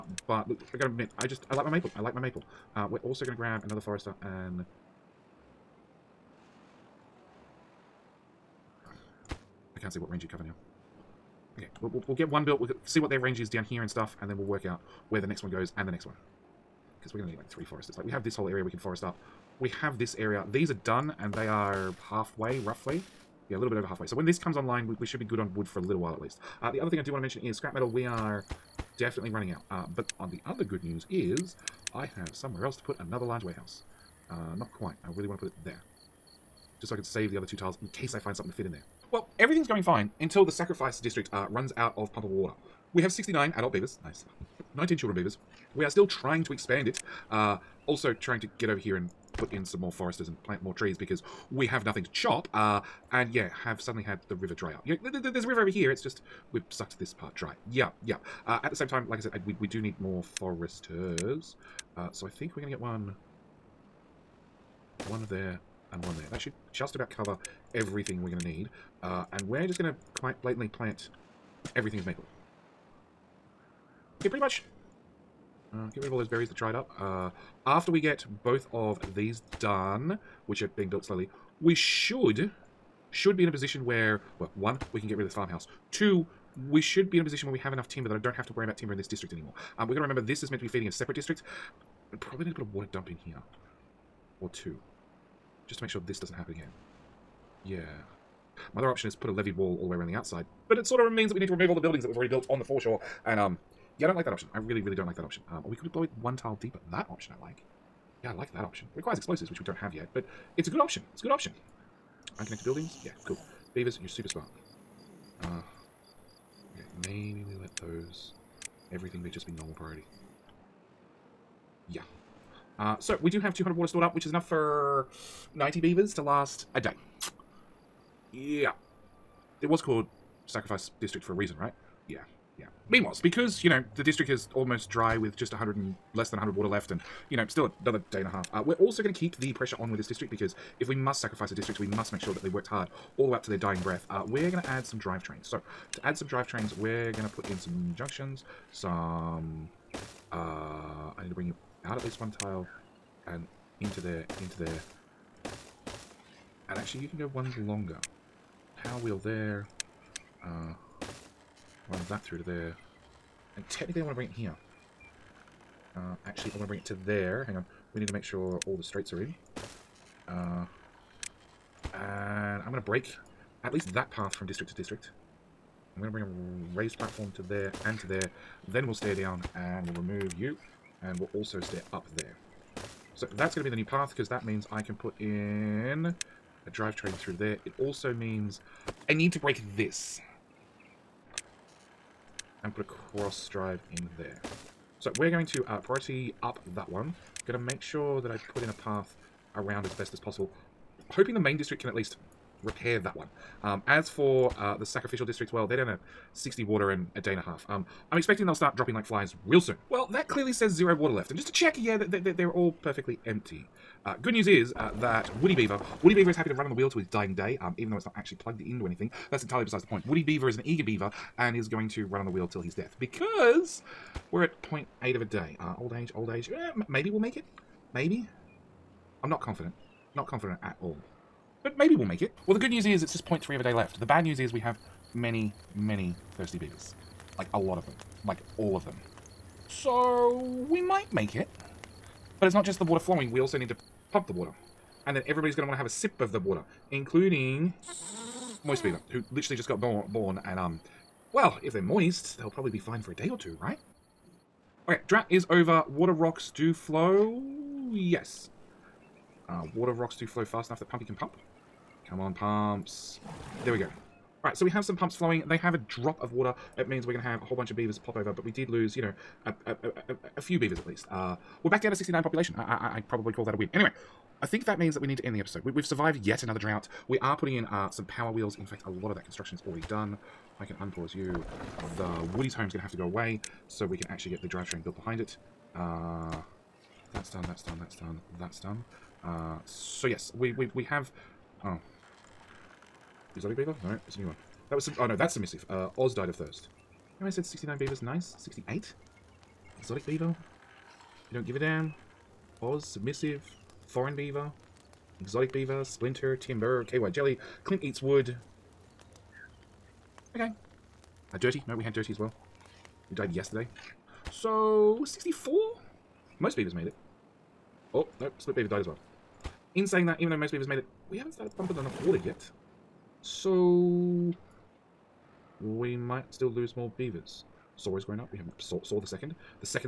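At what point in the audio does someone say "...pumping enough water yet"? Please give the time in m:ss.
5:21.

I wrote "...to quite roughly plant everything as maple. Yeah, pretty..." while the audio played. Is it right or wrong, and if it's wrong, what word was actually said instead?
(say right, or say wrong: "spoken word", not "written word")
wrong: "blatantly", not "roughly".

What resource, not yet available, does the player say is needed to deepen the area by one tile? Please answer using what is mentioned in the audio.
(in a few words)
explosives.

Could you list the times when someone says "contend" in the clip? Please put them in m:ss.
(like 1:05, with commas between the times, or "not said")
not said.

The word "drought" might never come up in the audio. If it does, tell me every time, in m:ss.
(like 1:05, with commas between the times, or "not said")
4:15, 4:36.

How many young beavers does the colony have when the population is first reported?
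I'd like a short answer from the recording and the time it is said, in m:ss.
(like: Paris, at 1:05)
19, at 0:44.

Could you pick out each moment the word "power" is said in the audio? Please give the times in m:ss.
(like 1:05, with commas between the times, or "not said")
2:38, 4:38.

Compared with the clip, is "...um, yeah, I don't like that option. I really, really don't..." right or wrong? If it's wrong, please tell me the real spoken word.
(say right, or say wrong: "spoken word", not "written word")
right.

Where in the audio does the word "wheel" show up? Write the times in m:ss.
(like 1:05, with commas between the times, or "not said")
2:39, 3:36, 3:42, 4:38.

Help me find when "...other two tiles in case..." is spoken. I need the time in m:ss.
0:37.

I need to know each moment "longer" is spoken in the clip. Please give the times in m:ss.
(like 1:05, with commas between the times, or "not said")
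2:37.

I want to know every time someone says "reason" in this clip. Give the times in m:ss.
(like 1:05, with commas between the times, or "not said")
2:11.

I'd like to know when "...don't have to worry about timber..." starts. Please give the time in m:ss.
1:28.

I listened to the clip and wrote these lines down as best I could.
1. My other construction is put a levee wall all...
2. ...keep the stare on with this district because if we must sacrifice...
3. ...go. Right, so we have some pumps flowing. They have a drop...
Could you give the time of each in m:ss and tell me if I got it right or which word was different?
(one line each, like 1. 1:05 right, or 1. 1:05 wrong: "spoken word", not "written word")
1. 1:38 wrong: "option", not "construction"
2. 2:19 wrong: "pressure", not "stare"
3. 4:23 right.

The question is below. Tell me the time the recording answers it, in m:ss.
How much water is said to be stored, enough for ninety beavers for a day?
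2:03.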